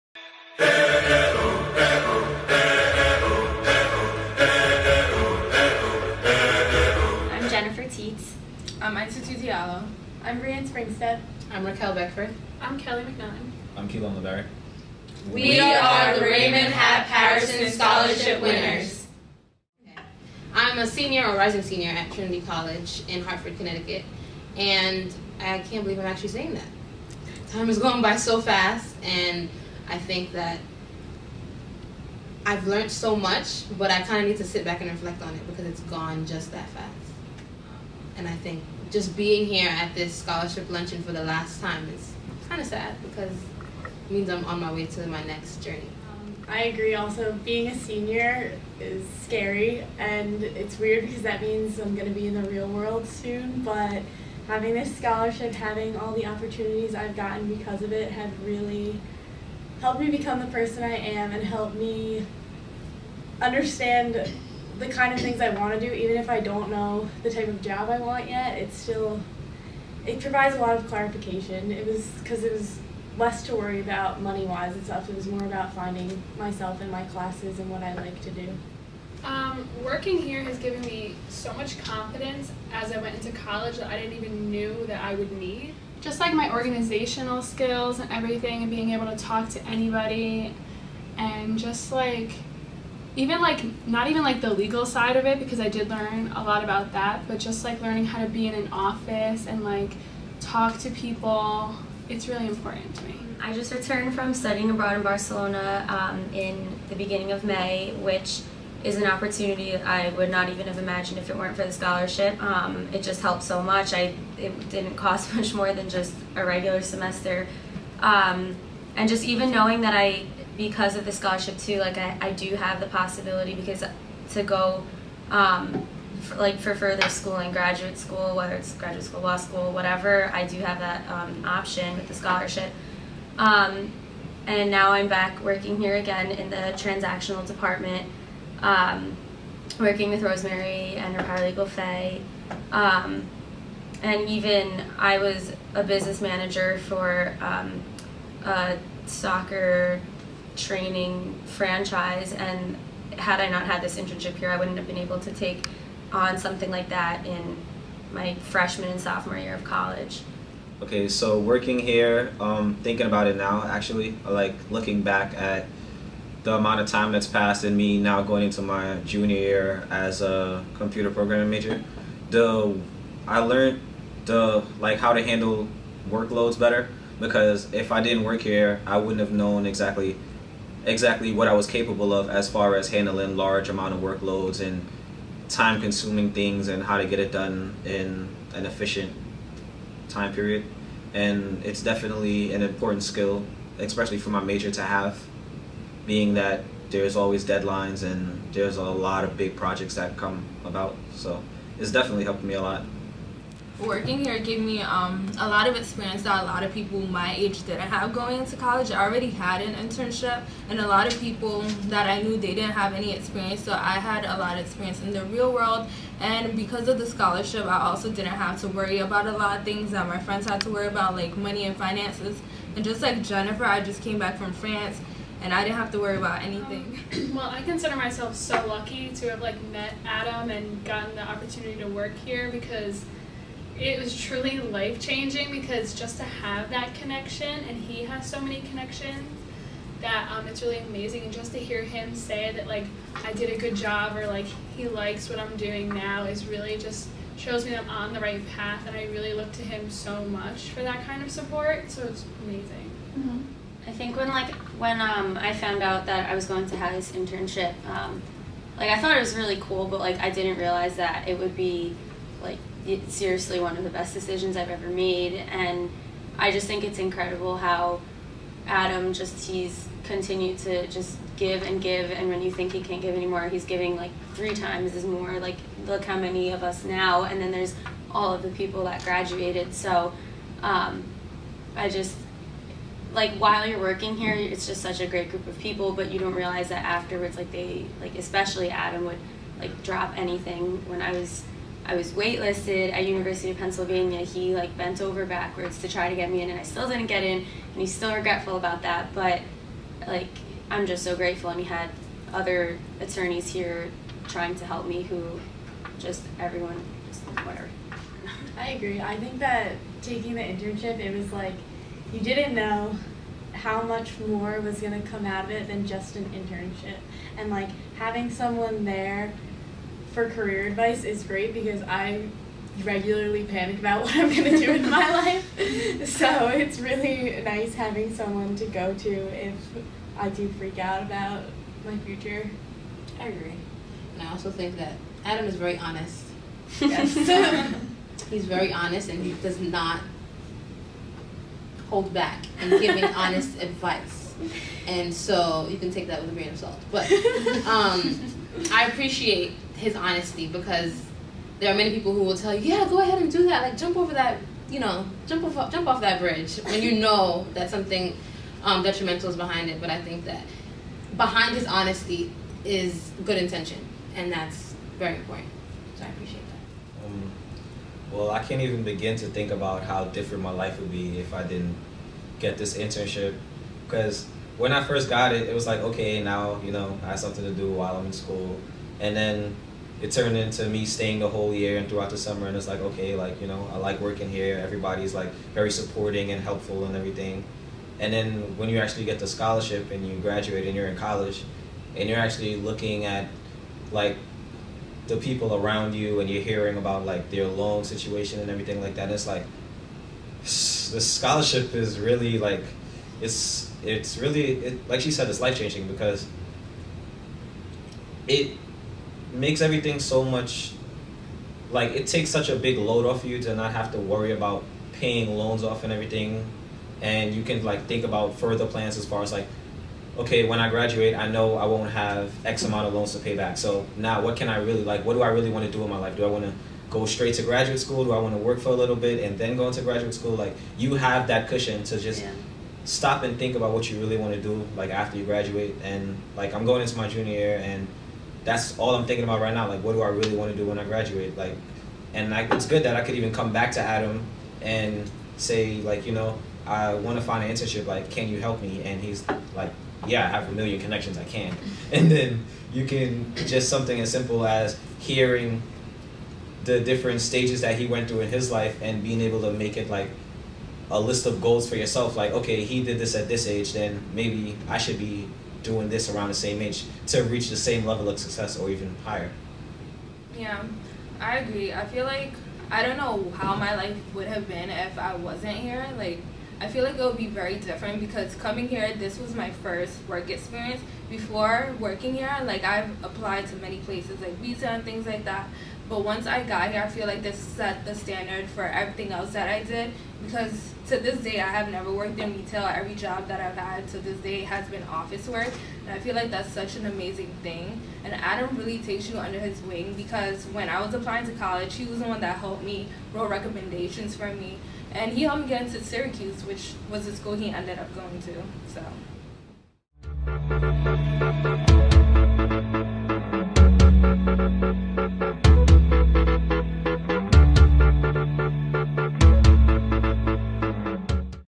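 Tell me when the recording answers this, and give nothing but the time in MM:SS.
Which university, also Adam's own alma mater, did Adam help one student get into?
08:25.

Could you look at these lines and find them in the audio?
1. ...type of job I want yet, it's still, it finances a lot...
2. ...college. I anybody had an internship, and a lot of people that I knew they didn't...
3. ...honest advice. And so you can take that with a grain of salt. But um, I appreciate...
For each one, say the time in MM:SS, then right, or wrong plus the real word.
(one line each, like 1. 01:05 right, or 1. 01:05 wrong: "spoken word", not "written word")
1. 01:07 wrong: "provides", not "finances"
2. 03:28 wrong: "already", not "anybody"
3. 05:43 right.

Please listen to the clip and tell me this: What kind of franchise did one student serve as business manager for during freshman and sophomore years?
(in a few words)
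soccer training franchise.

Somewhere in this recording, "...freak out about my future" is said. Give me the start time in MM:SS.
05:30.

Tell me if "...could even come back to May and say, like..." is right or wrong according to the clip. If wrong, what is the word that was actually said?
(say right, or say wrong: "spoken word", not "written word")
wrong: "Adam", not "May".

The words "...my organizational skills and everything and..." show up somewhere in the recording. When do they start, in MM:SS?
01:26.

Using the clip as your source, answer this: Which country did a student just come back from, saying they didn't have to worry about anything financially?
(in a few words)
France.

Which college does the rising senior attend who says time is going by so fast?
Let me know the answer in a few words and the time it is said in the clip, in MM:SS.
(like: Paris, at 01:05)
Trinity College, at 00:22.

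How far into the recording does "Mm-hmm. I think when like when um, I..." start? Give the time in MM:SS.
04:13.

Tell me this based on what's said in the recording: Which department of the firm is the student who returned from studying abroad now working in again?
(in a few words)
transactional department.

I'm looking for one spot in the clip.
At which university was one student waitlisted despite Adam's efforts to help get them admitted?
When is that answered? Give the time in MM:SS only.
04:53.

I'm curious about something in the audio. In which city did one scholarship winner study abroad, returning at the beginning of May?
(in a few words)
Barcelona.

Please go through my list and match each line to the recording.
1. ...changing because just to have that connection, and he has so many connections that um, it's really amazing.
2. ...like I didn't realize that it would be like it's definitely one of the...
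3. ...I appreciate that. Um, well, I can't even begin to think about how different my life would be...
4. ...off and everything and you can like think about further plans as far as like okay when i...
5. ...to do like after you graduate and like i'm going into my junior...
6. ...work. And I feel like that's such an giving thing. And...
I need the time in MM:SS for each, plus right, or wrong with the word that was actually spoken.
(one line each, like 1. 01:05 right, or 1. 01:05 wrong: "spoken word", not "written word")
1. 03:54 right
2. 04:19 wrong: "seriously", not "definitely"
3. 06:06 right
4. 06:55 right
5. 07:14 right
6. 08:15 wrong: "amazing", not "giving".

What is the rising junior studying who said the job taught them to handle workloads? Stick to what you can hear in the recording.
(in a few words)
computer programming.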